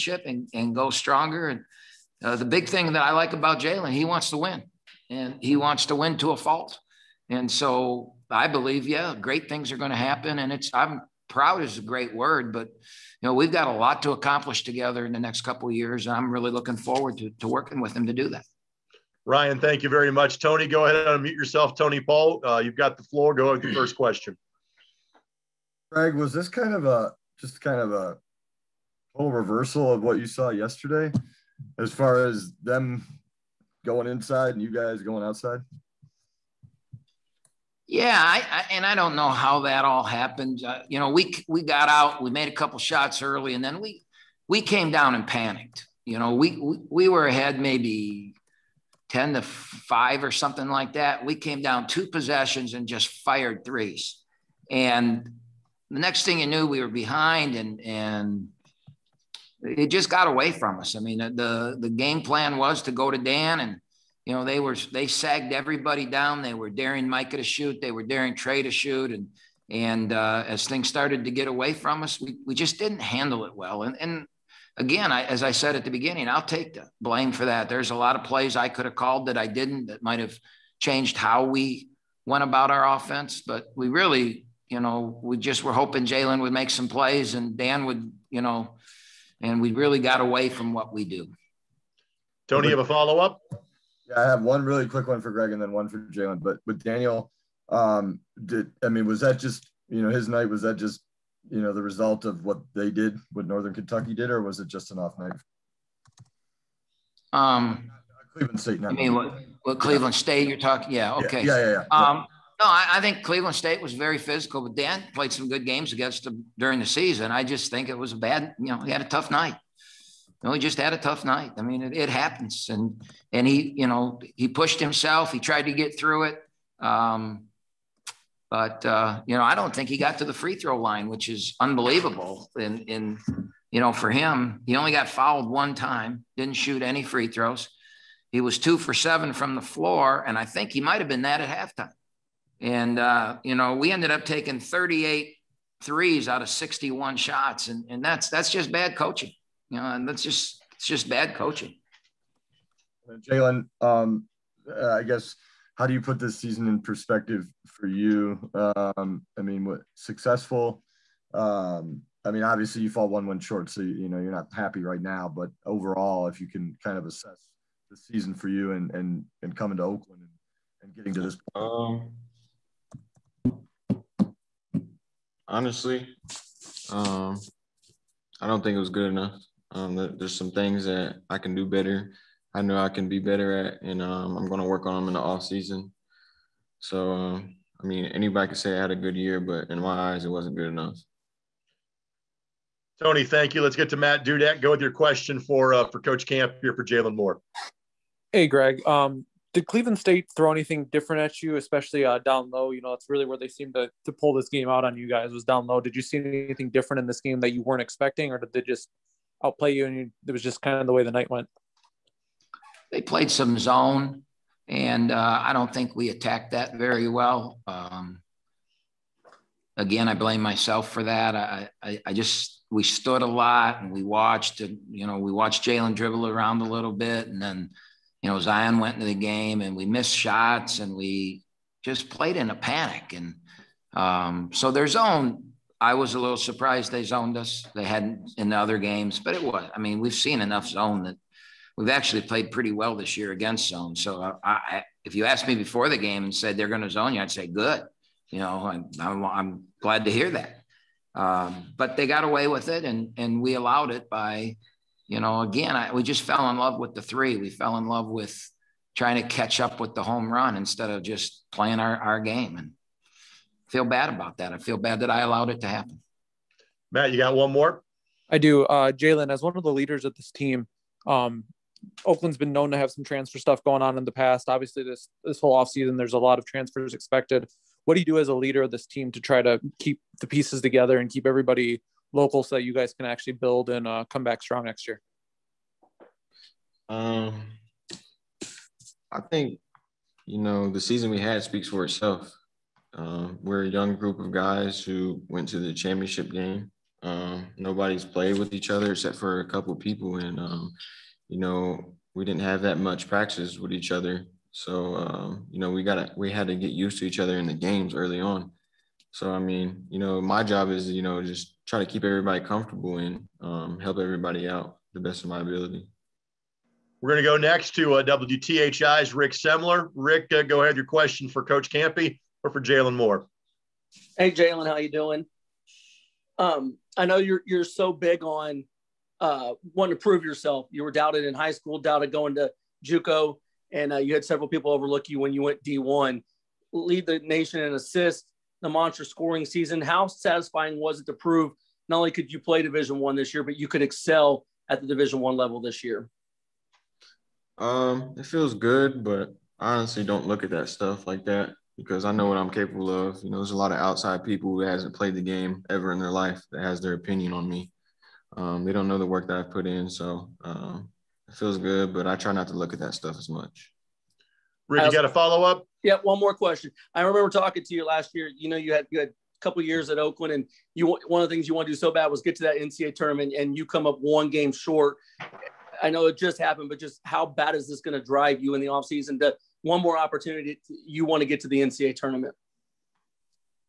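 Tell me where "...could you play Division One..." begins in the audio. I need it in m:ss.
5:42.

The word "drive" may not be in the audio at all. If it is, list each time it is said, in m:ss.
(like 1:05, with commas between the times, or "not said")
6:18.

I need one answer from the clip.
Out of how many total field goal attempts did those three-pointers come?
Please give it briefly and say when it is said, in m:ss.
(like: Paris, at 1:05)
61, at 2:26.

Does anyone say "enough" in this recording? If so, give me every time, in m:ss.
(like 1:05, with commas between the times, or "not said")
2:59, 3:10, 4:00.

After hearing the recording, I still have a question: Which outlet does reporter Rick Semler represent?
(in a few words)
WTHI.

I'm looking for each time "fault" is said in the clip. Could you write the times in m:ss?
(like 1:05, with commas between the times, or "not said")
0:06.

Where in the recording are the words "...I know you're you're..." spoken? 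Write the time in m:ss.
5:26.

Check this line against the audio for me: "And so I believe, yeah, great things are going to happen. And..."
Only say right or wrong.
right.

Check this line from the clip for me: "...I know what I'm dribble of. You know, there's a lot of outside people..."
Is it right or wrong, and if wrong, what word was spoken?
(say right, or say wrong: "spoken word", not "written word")
wrong: "capable", not "dribble".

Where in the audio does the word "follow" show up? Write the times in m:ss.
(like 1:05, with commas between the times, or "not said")
1:32, 6:05.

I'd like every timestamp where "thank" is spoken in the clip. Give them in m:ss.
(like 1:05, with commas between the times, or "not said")
0:19, 3:13.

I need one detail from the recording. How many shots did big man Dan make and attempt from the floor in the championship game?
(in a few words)
2 for 7.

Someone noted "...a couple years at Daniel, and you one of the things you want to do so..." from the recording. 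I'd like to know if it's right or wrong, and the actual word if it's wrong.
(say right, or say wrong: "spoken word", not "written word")
wrong: "Oakland", not "Daniel".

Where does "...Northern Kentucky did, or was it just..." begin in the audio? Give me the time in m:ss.
1:43.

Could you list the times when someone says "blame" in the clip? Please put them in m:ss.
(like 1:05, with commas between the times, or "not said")
1:17, 3:40.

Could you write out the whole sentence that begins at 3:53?
And um, so their zone, I was a little surprised they zoned us.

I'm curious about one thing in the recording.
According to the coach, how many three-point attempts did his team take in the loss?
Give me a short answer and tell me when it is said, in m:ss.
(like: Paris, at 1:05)
38, at 2:24.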